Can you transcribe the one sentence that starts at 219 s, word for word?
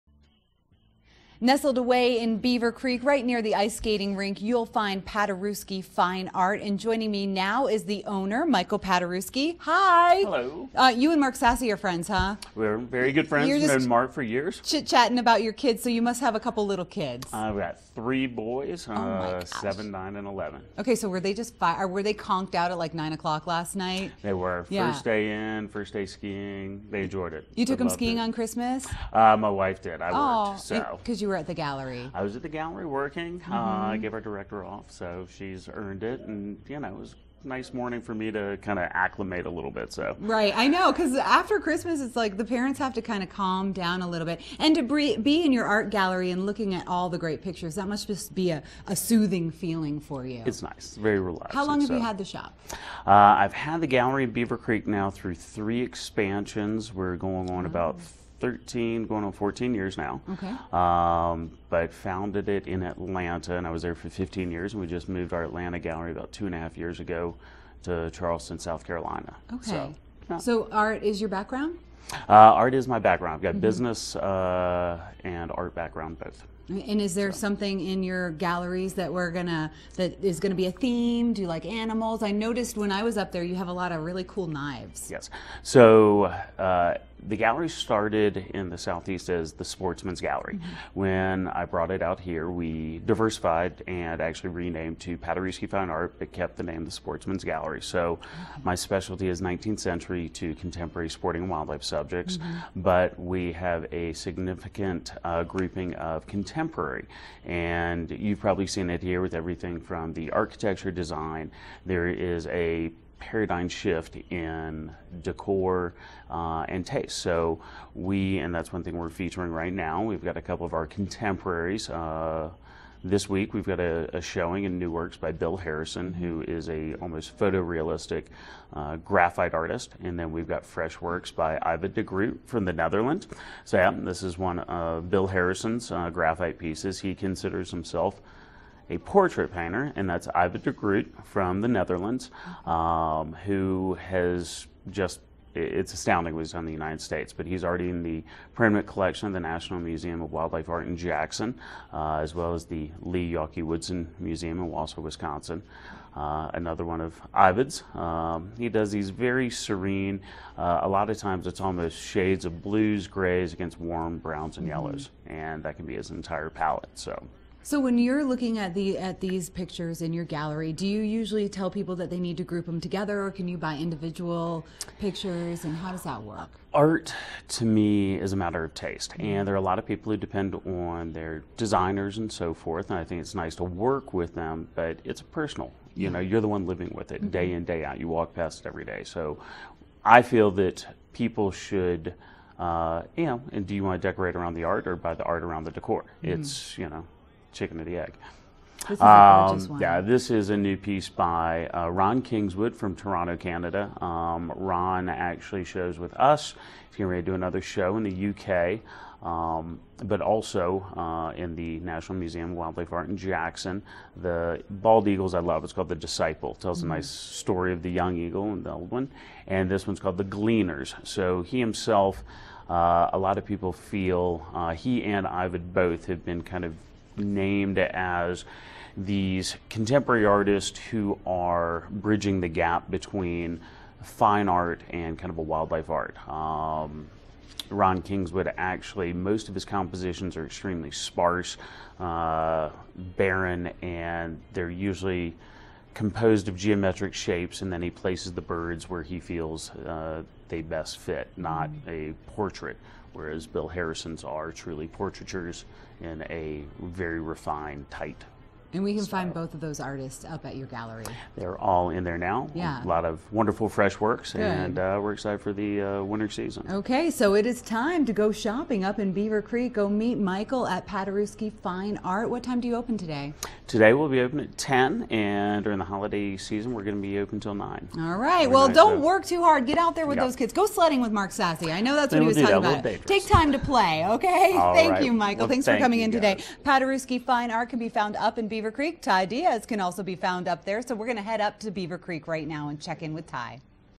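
And this one's called The Gleaners.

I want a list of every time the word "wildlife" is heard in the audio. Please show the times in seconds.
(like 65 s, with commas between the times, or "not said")
101 s, 150 s, 212 s, 235 s.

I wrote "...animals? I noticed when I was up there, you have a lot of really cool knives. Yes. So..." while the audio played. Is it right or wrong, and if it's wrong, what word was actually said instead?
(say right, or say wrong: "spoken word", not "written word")
right.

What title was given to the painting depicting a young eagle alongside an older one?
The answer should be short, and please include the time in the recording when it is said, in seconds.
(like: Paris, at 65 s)
The Disciple, at 215 s.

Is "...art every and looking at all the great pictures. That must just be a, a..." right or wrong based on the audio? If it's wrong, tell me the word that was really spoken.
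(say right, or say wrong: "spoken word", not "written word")
wrong: "gallery", not "every".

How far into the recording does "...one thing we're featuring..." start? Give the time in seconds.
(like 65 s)
118 s.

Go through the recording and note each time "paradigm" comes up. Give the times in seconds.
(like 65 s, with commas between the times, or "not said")
113 s.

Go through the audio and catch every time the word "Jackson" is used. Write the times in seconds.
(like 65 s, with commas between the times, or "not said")
150 s, 213 s.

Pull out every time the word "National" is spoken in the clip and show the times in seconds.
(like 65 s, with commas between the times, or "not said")
149 s, 211 s.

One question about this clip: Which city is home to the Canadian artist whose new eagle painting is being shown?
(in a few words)
Toronto.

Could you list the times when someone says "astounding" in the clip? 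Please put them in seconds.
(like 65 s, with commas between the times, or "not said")
145 s.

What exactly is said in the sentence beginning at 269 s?
Go meet Michael at Paderewski Fine Art.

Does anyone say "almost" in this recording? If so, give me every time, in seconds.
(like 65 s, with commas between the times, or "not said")
126 s, 161 s.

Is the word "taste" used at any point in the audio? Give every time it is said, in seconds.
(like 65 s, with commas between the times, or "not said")
116 s, 178 s.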